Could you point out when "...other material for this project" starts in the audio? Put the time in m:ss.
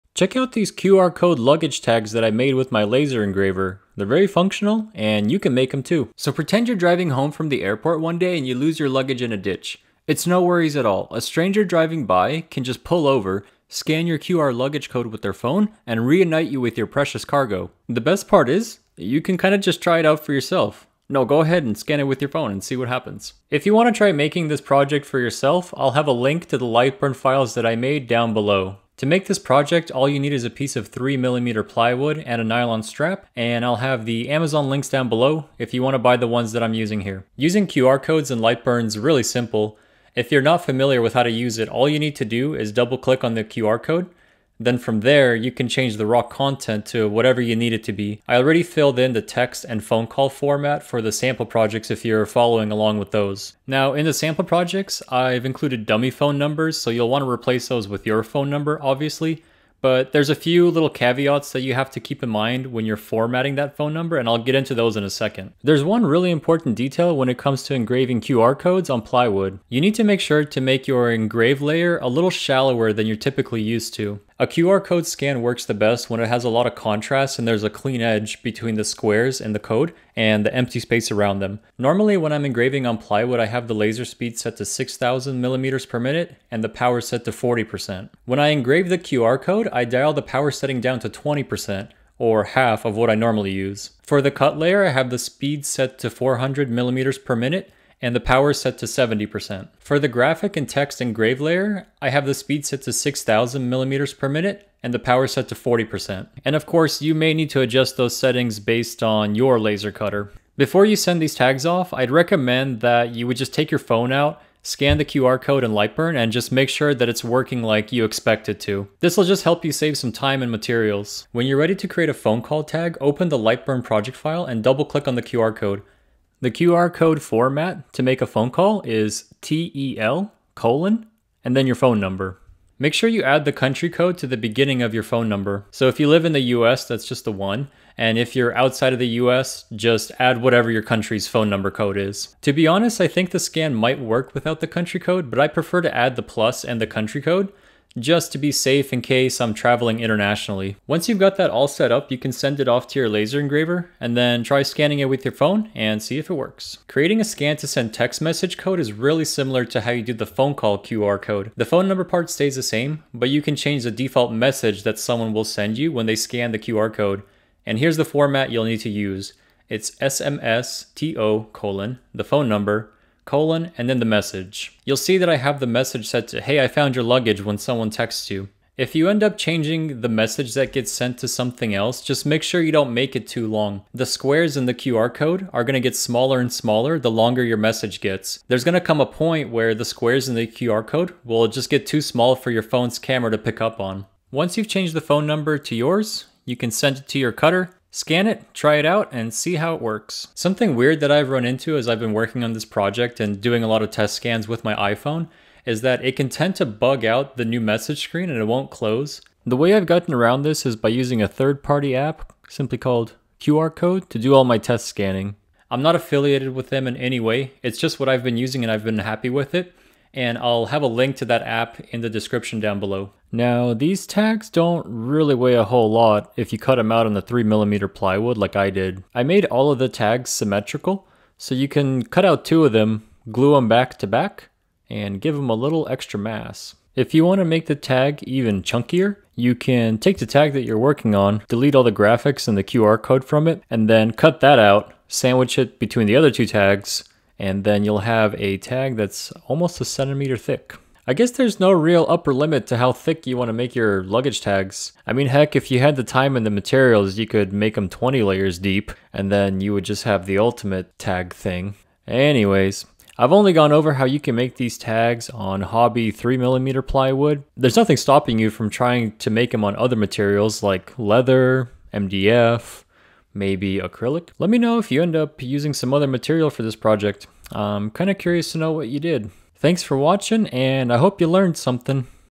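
4:35.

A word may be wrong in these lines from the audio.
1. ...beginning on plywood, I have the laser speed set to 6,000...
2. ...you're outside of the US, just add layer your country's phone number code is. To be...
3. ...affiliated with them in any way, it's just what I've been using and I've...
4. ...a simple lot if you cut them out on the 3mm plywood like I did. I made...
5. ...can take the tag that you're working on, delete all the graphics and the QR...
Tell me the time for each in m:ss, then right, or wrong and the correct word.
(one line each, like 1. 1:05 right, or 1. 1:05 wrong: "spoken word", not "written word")
1. 1:22 wrong: "engraving", not "beginning"
2. 2:18 wrong: "whatever", not "layer"
3. 3:35 right
4. 3:45 wrong: "whole", not "simple"
5. 3:59 right.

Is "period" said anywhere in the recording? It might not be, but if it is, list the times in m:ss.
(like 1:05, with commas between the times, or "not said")
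not said.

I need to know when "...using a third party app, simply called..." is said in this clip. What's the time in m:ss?
3:30.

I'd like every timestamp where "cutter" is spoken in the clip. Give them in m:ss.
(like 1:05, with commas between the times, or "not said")
1:49, 3:17.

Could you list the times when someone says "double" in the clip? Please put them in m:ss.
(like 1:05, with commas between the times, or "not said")
0:42, 2:04.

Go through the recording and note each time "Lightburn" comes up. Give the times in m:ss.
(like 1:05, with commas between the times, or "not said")
0:26, 0:38, 1:55, 2:03.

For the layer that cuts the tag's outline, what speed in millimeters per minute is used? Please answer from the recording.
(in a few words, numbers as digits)
400.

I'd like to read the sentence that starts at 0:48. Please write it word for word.
I already filled in the text and phone call format for the sample projects if you're following along with those.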